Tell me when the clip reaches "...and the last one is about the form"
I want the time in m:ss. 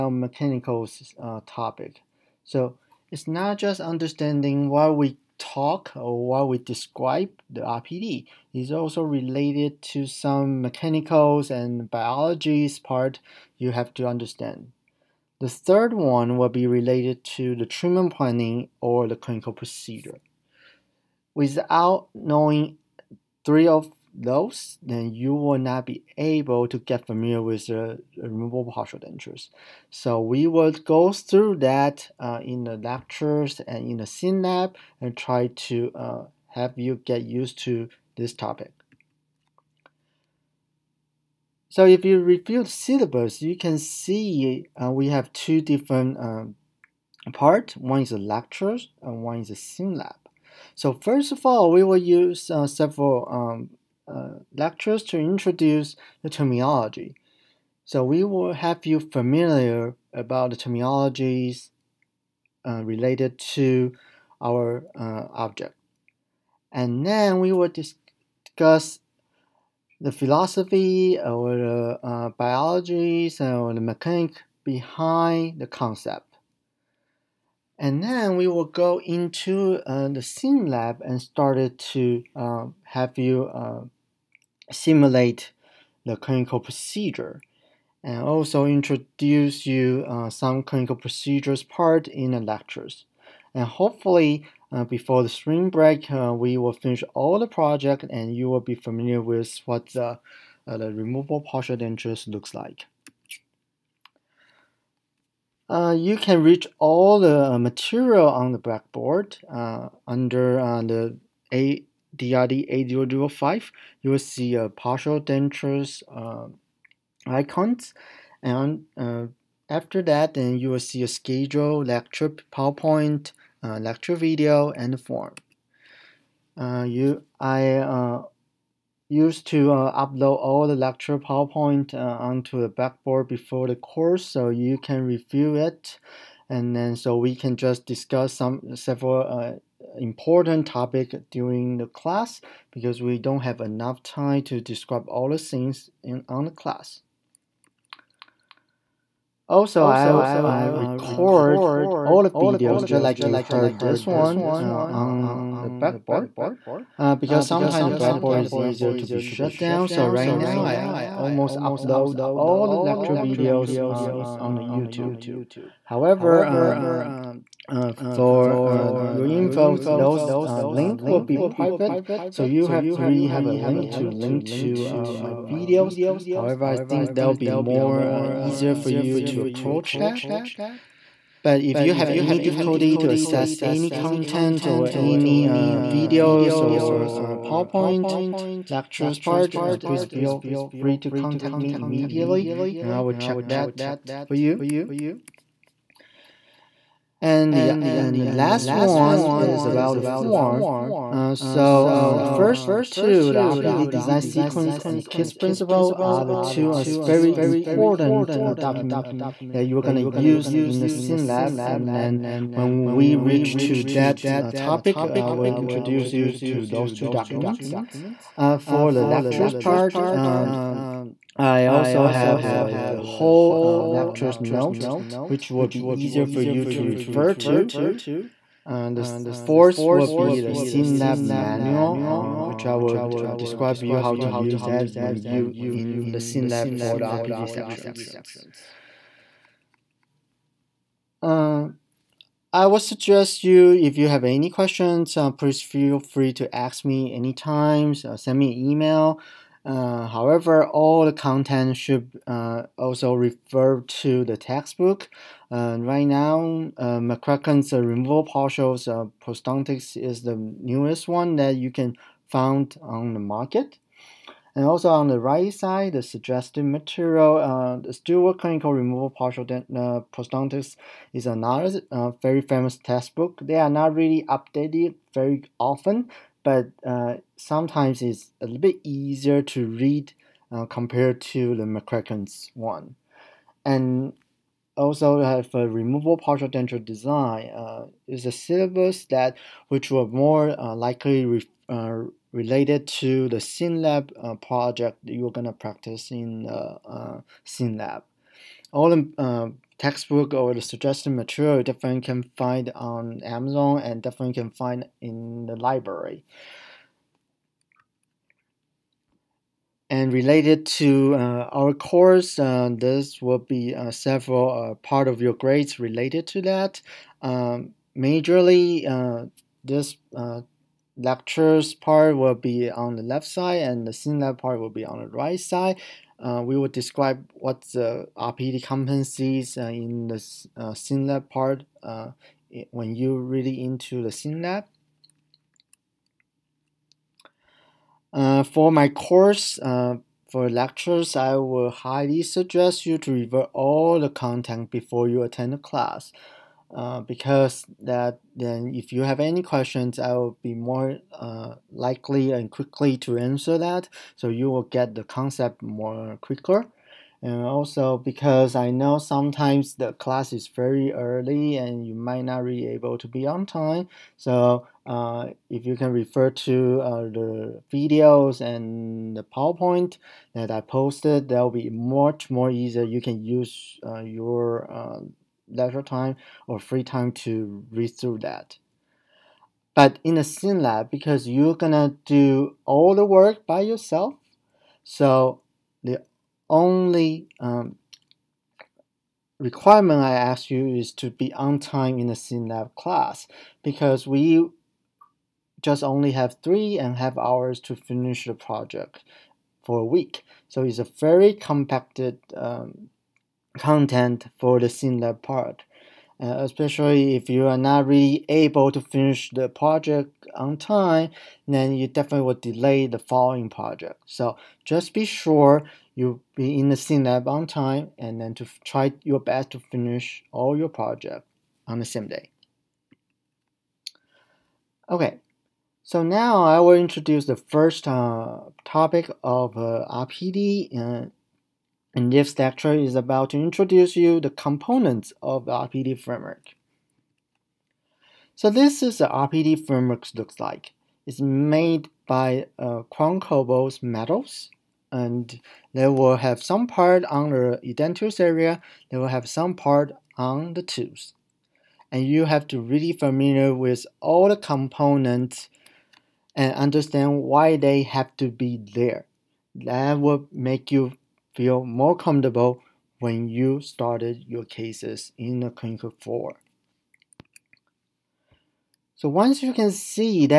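3:17.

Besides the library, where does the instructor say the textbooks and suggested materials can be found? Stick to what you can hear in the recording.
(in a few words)
Amazon.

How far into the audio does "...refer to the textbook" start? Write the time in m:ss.
4:13.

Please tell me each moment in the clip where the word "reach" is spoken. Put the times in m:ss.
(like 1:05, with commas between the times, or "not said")
1:46, 3:33.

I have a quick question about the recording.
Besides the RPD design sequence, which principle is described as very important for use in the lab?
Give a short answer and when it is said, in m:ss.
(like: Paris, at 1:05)
KISS principle, at 3:25.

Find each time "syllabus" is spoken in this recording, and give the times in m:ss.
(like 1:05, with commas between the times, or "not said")
0:42, 4:48.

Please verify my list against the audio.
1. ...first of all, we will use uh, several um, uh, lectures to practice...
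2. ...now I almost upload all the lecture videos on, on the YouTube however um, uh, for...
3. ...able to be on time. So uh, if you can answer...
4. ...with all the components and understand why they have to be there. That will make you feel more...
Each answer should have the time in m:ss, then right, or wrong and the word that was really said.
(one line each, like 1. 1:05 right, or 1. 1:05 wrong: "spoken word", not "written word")
1. 0:50 wrong: "introduce", not "practice"
2. 2:40 right
3. 6:02 wrong: "refer", not "answer"
4. 7:33 right.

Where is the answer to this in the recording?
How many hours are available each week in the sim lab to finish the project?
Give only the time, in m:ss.
6:36.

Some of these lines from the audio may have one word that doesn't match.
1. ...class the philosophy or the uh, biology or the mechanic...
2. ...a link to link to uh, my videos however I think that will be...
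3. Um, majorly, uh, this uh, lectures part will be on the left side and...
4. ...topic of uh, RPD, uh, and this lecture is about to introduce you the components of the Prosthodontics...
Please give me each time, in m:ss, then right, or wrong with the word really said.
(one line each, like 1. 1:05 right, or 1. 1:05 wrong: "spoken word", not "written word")
1. 1:07 wrong: "discuss", not "class"
2. 2:53 right
3. 5:17 right
4. 7:08 wrong: "RPD", not "Prosthodontics".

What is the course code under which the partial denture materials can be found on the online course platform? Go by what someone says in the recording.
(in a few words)
ADRD 8005.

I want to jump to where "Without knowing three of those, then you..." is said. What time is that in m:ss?
0:21.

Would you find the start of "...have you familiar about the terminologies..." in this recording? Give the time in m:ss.
0:58.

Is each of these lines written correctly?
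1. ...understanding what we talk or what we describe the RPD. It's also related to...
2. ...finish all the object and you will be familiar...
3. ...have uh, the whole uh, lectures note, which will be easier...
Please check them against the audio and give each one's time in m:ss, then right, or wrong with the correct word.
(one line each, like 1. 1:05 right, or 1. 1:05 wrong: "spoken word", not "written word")
1. 0:03 right
2. 1:36 wrong: "project", not "object"
3. 3:42 right.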